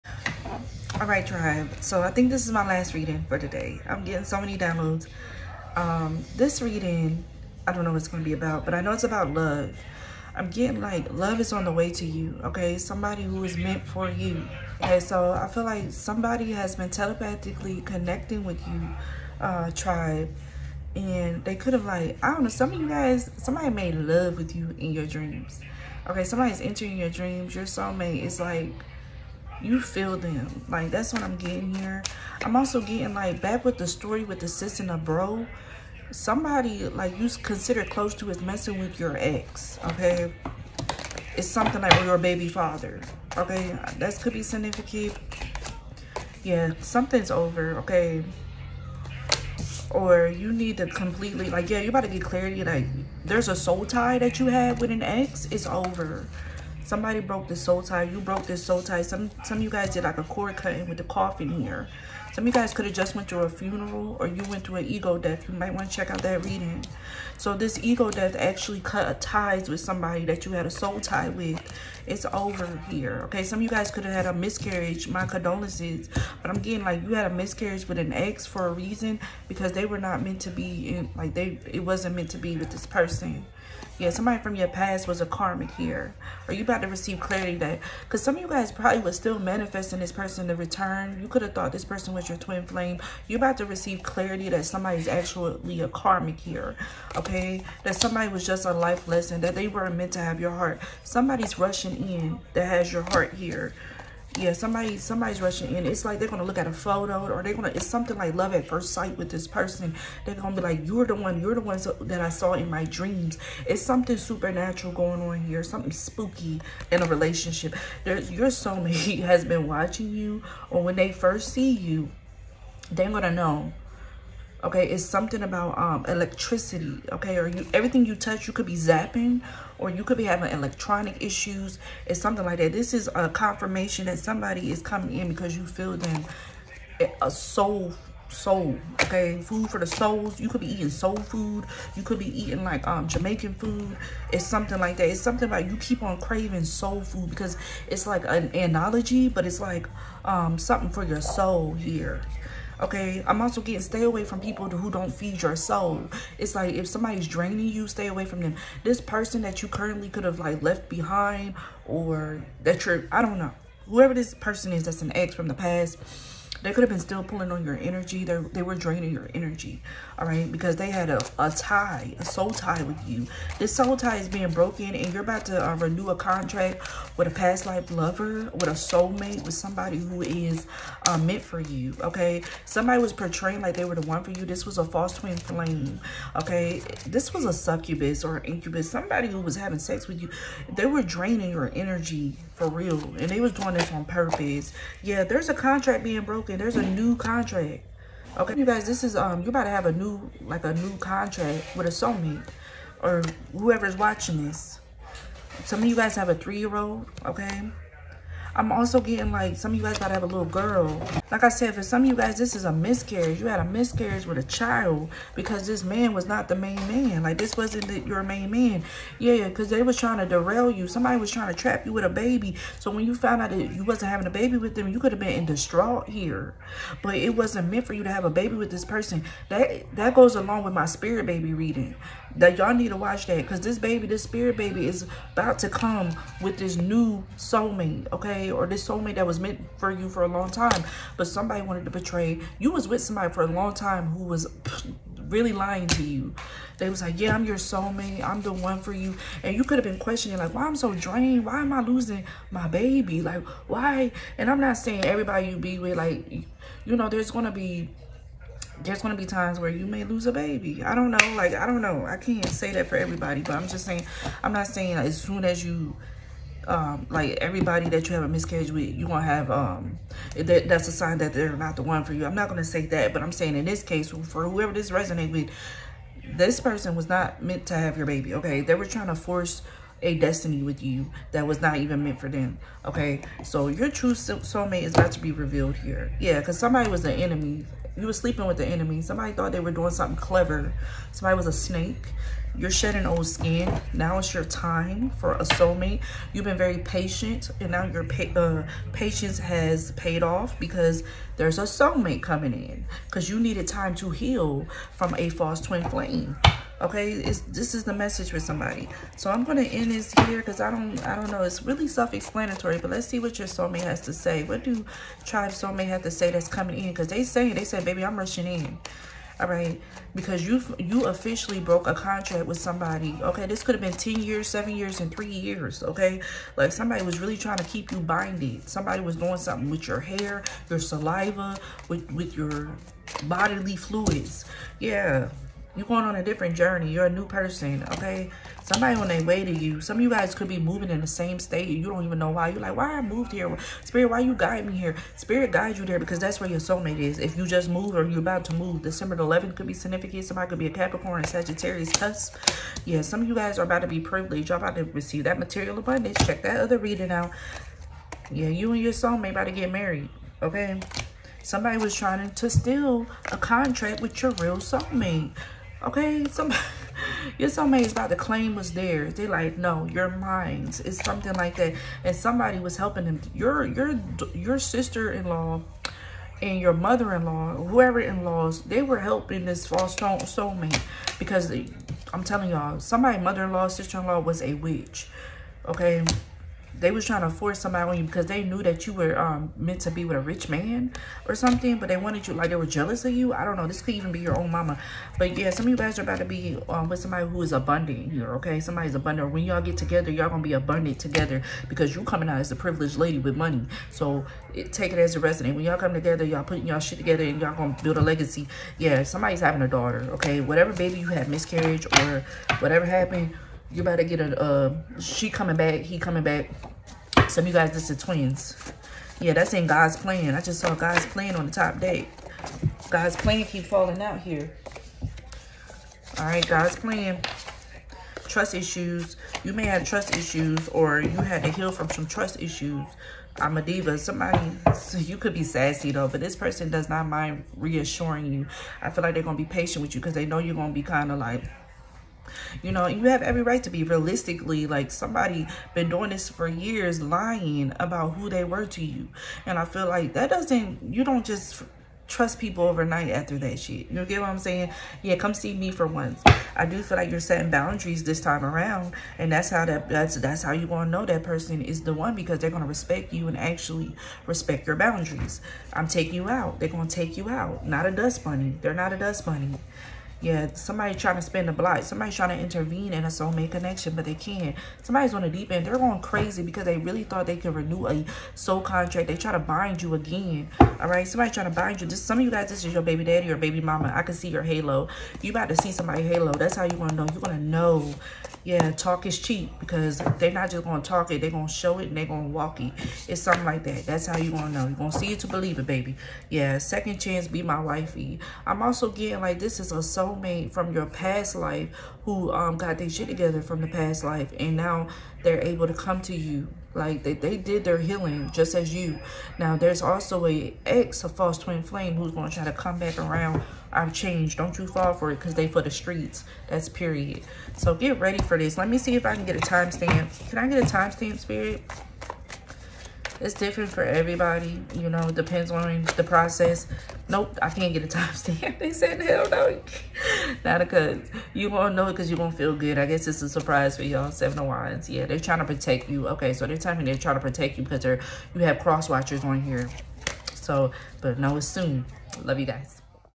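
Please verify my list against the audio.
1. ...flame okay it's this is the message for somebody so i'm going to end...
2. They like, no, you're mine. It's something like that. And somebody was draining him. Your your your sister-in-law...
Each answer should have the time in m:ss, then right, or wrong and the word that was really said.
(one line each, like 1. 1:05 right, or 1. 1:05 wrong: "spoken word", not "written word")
1. 5:05 right
2. 6:09 wrong: "helping", not "draining".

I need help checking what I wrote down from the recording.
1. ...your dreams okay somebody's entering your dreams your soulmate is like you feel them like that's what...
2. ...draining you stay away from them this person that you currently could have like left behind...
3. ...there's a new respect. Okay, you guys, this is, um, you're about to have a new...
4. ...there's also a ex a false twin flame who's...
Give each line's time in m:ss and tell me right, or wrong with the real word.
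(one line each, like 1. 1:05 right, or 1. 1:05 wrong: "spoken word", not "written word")
1. 0:24 right
2. 2:37 right
3. 3:16 wrong: "contract", not "respect"
4. 8:29 right.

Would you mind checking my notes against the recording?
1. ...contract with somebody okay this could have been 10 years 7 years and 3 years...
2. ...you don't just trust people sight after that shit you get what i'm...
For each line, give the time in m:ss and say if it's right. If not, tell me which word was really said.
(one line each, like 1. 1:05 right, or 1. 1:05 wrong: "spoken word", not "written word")
1. 5:21 right
2. 7:30 wrong: "overnight", not "sight".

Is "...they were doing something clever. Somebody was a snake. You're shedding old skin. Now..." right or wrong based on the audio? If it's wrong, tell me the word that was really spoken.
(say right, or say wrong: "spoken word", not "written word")
right.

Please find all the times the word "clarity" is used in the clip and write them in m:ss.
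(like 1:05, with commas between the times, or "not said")
0:52, 1:27, 1:34.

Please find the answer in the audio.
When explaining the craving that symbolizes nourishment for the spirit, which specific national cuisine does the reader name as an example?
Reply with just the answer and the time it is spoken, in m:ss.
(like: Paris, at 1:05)
Jamaican food, at 2:23.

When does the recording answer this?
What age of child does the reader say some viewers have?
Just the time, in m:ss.
3:26.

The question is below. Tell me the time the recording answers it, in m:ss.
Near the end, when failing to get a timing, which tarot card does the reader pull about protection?
8:54.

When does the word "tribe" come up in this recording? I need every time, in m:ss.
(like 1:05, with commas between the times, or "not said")
0:01, 0:19, 5:15.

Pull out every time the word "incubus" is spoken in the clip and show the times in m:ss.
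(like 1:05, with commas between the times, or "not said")
3:08.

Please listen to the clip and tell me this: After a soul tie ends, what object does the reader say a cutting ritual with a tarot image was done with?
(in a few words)
coffin.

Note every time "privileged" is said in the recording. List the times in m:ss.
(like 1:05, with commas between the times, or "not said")
5:54, 6:42.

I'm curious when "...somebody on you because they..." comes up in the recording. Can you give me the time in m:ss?
6:27.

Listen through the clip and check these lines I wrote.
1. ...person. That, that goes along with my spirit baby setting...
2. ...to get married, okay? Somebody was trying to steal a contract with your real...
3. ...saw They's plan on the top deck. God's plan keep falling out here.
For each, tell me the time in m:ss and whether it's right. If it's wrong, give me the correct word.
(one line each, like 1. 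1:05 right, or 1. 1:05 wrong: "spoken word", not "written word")
1. 3:48 wrong: "reading", not "setting"
2. 5:59 right
3. 7:00 wrong: "God", not "They".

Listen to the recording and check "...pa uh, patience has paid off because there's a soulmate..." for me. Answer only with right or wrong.
right.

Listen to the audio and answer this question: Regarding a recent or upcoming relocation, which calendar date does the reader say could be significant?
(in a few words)
December 11th.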